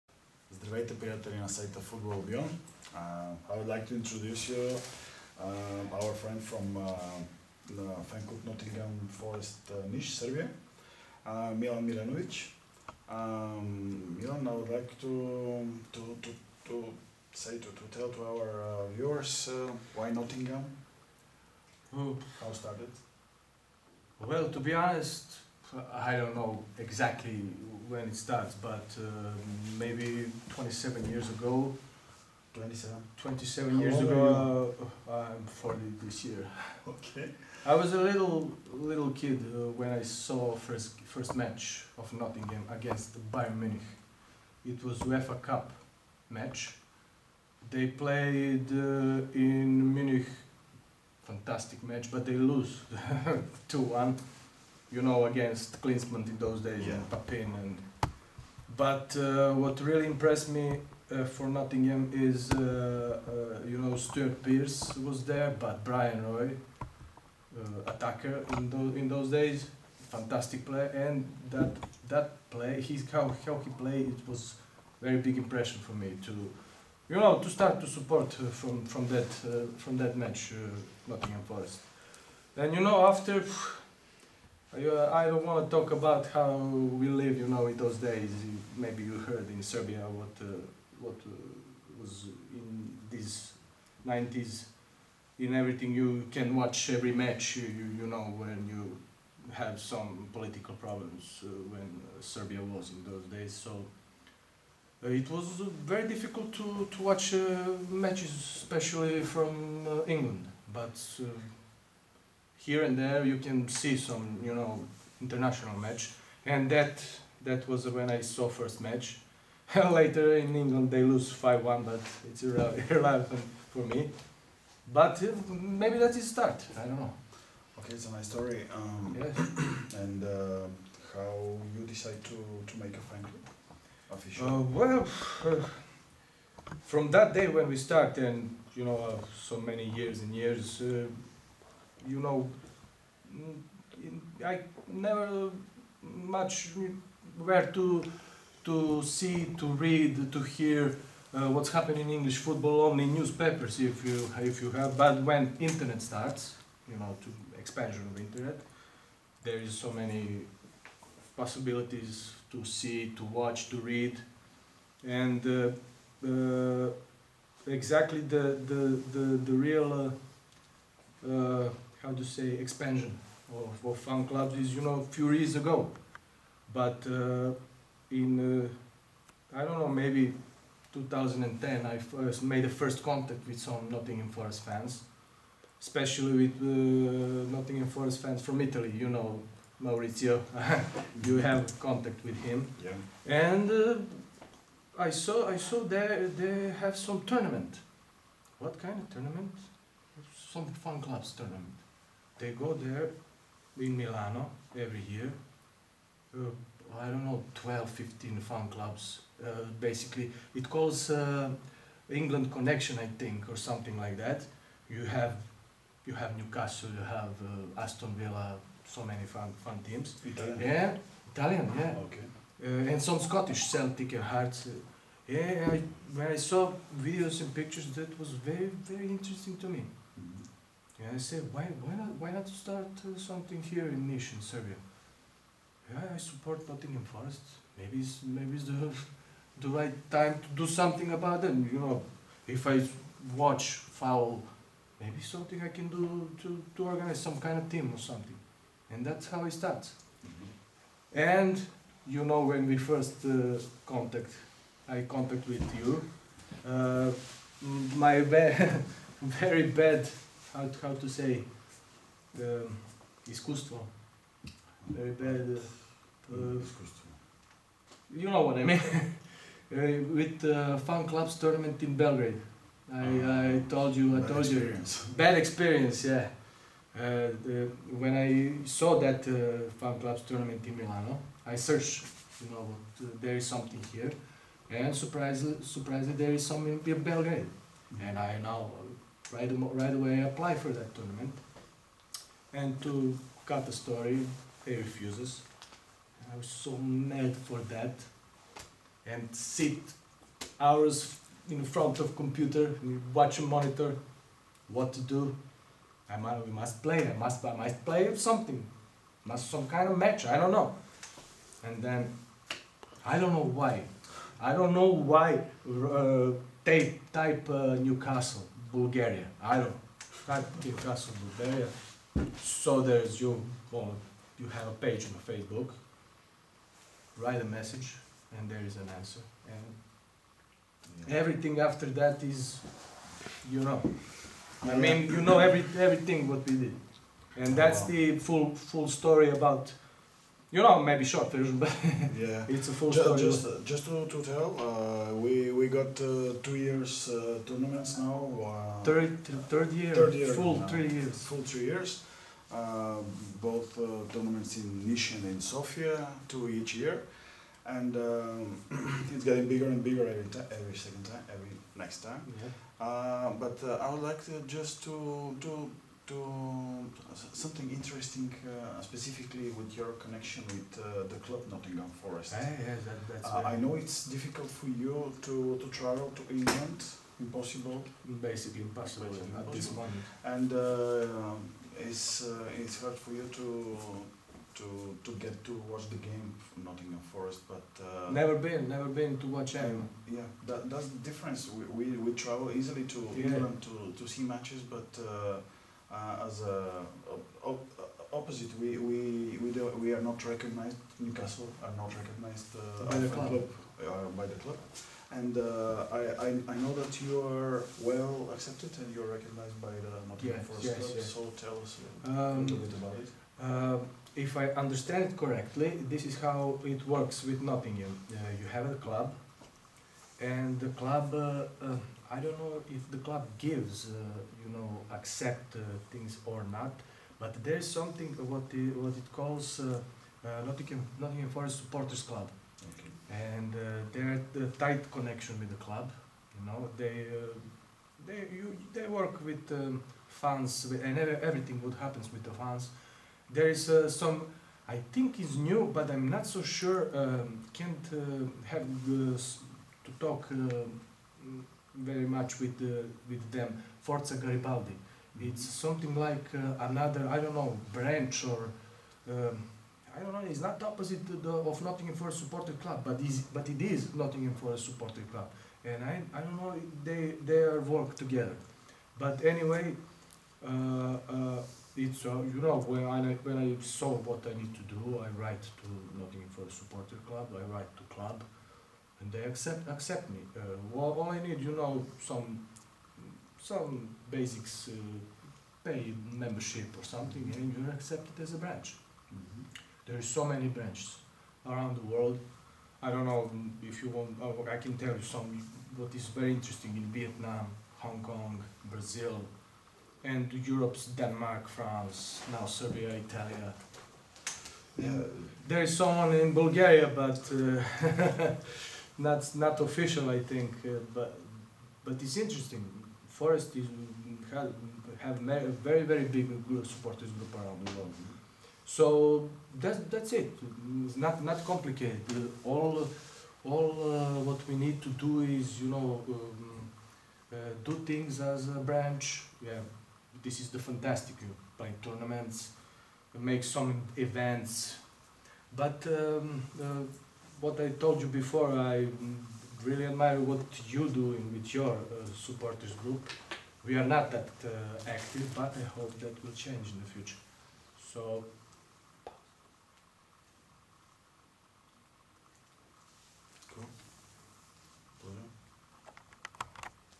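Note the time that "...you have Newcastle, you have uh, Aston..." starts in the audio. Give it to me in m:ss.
3:36.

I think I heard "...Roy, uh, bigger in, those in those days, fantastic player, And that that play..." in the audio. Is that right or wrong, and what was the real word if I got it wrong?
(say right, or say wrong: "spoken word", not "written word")
wrong: "attacker", not "bigger".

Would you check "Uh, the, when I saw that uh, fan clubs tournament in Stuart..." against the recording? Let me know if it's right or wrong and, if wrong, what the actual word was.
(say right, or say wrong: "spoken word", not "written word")
wrong: "Milano", not "Stuart".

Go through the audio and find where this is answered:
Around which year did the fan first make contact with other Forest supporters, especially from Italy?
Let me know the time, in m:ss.
3:00.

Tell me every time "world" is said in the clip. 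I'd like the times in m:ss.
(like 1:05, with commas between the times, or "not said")
8:11, 8:37.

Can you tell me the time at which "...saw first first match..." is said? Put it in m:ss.
0:40.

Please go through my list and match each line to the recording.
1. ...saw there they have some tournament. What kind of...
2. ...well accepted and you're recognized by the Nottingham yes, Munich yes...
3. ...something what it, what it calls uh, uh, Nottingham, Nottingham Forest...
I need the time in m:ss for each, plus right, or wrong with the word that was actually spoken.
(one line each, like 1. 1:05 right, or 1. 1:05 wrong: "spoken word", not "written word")
1. 3:15 right
2. 6:47 wrong: "Forest", not "Munich"
3. 7:07 right.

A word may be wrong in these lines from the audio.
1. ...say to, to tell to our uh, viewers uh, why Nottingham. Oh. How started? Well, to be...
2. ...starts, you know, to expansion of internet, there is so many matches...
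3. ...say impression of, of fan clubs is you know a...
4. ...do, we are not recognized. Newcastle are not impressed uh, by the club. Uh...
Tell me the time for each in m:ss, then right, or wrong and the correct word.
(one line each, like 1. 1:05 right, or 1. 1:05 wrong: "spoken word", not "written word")
1. 0:17 right
2. 2:36 wrong: "possibilities", not "matches"
3. 2:52 wrong: "expansion", not "impression"
4. 6:39 wrong: "recognized", not "impressed".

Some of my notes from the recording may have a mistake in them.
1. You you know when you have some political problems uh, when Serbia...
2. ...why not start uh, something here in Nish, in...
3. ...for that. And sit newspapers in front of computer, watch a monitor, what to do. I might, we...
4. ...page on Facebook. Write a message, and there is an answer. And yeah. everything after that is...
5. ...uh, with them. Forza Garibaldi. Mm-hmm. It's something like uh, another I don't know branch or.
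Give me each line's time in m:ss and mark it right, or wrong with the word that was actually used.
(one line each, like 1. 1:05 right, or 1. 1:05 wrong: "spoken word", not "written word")
1. 1:37 right
2. 3:52 right
3. 4:57 wrong: "hours", not "newspapers"
4. 5:24 right
5. 7:32 right.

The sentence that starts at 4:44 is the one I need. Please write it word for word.
And surprisingly, surprisingly there is something in Belgrade.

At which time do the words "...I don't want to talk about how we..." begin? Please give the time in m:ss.
1:25.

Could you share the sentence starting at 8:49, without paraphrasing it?
Yeah, this is the fantastic by tournaments, make some events, but.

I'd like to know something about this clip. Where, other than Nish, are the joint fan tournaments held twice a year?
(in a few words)
Sofia.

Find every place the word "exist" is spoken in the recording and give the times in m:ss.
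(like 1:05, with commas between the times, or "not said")
not said.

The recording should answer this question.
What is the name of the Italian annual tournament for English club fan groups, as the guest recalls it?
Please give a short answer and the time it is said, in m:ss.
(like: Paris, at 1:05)
England Connection, at 3:32.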